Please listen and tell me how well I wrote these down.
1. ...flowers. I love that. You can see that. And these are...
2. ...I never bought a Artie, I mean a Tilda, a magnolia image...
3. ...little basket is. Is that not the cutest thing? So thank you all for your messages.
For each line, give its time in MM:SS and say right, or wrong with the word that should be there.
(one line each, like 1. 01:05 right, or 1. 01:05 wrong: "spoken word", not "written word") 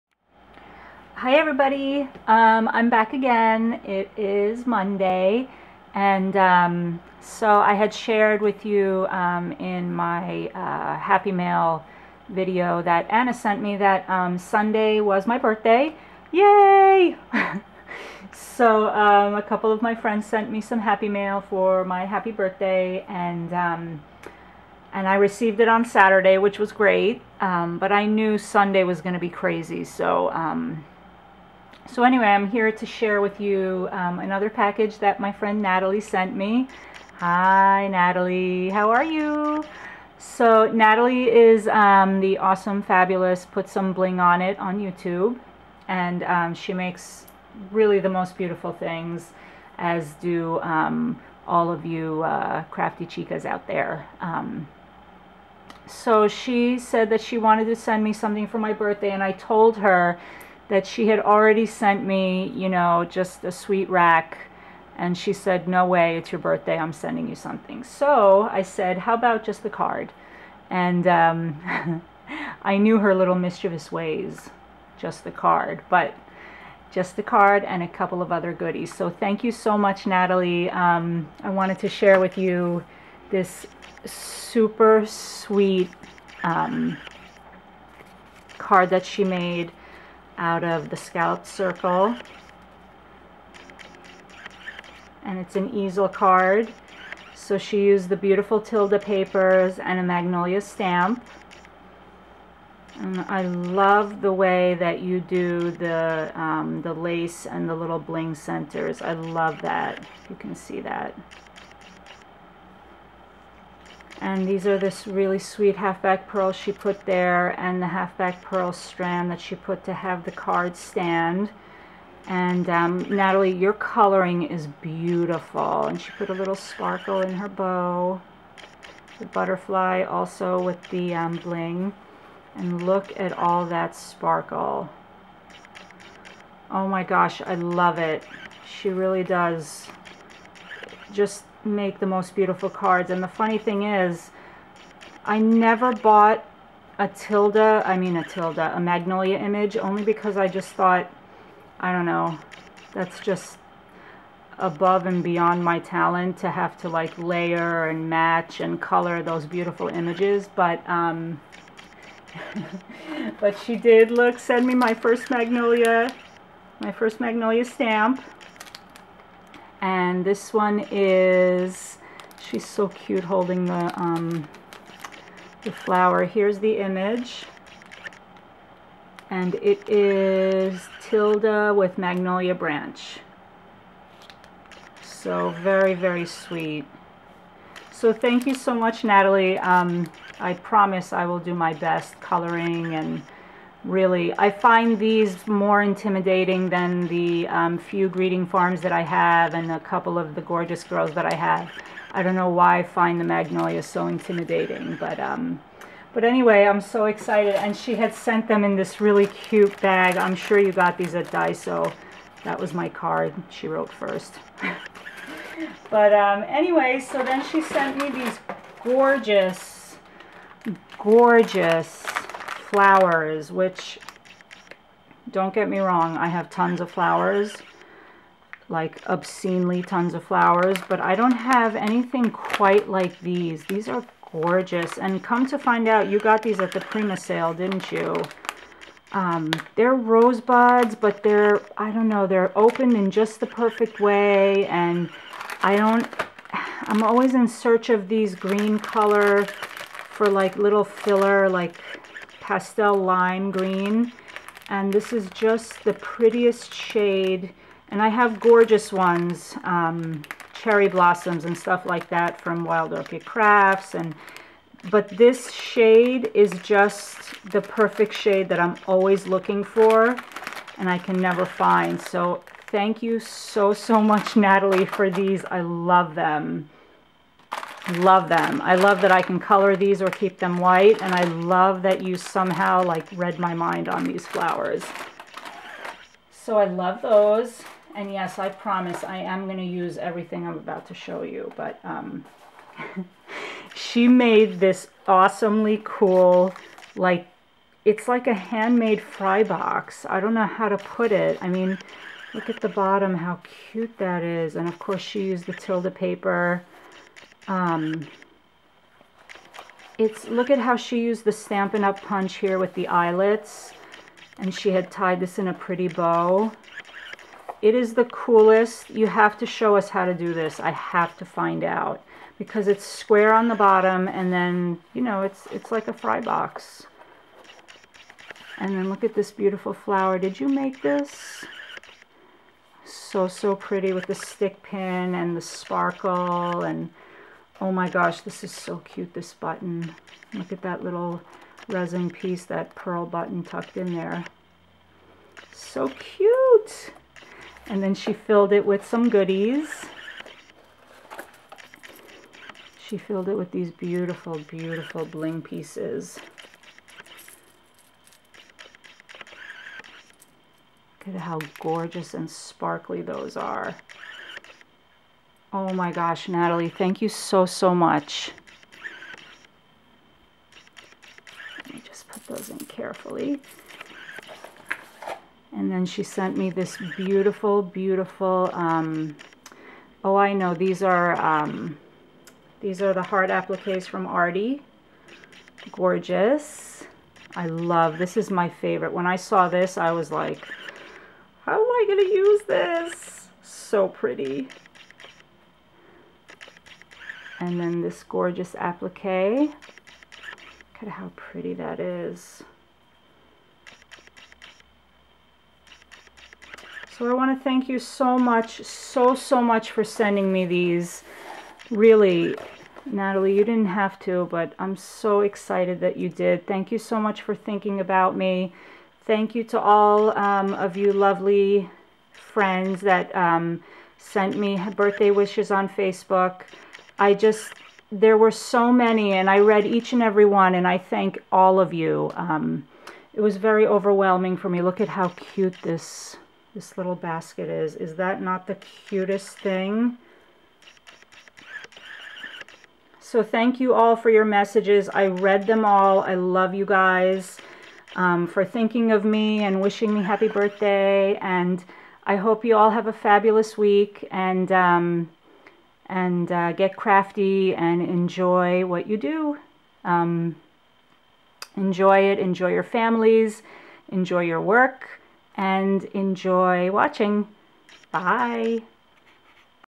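1. 01:48 wrong: "centers", not "flowers"
2. 02:25 wrong: "Tilda", not "Artie"
3. 07:16 right.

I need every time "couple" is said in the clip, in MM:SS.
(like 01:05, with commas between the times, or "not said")
00:19, 01:17, 03:19.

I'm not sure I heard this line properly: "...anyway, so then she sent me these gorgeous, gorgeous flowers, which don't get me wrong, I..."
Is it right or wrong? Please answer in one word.
right.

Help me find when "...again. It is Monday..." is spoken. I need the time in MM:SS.
00:03.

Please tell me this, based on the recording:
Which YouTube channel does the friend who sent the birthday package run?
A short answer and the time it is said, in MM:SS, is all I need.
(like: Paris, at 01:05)
Put Some Bling On It, at 00:43.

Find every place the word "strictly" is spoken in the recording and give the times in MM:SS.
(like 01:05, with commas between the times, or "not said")
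not said.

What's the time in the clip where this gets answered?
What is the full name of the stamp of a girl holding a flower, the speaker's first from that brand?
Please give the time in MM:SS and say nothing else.
03:01.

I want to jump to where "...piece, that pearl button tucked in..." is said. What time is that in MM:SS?
05:42.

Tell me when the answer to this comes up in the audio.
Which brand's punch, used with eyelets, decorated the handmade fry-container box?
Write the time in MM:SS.
05:11.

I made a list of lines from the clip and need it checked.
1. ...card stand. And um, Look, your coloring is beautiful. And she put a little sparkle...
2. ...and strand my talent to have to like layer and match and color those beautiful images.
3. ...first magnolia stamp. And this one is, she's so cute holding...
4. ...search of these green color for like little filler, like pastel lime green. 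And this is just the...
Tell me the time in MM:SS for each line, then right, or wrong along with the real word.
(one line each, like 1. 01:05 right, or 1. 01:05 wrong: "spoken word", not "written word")
1. 02:00 wrong: "Natalie", not "Look"
2. 02:35 wrong: "beyond", not "strand"
3. 02:46 right
4. 04:07 right.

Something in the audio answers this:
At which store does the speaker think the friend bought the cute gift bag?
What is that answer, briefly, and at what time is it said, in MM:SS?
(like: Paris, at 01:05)
Daiso, at 03:31.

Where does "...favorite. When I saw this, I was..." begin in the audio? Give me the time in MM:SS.
06:28.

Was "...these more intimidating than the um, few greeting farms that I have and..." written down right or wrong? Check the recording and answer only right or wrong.
right.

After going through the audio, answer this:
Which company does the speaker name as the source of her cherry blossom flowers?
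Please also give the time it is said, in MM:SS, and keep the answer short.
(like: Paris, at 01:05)
Wild Orchid Crafts, at 04:22.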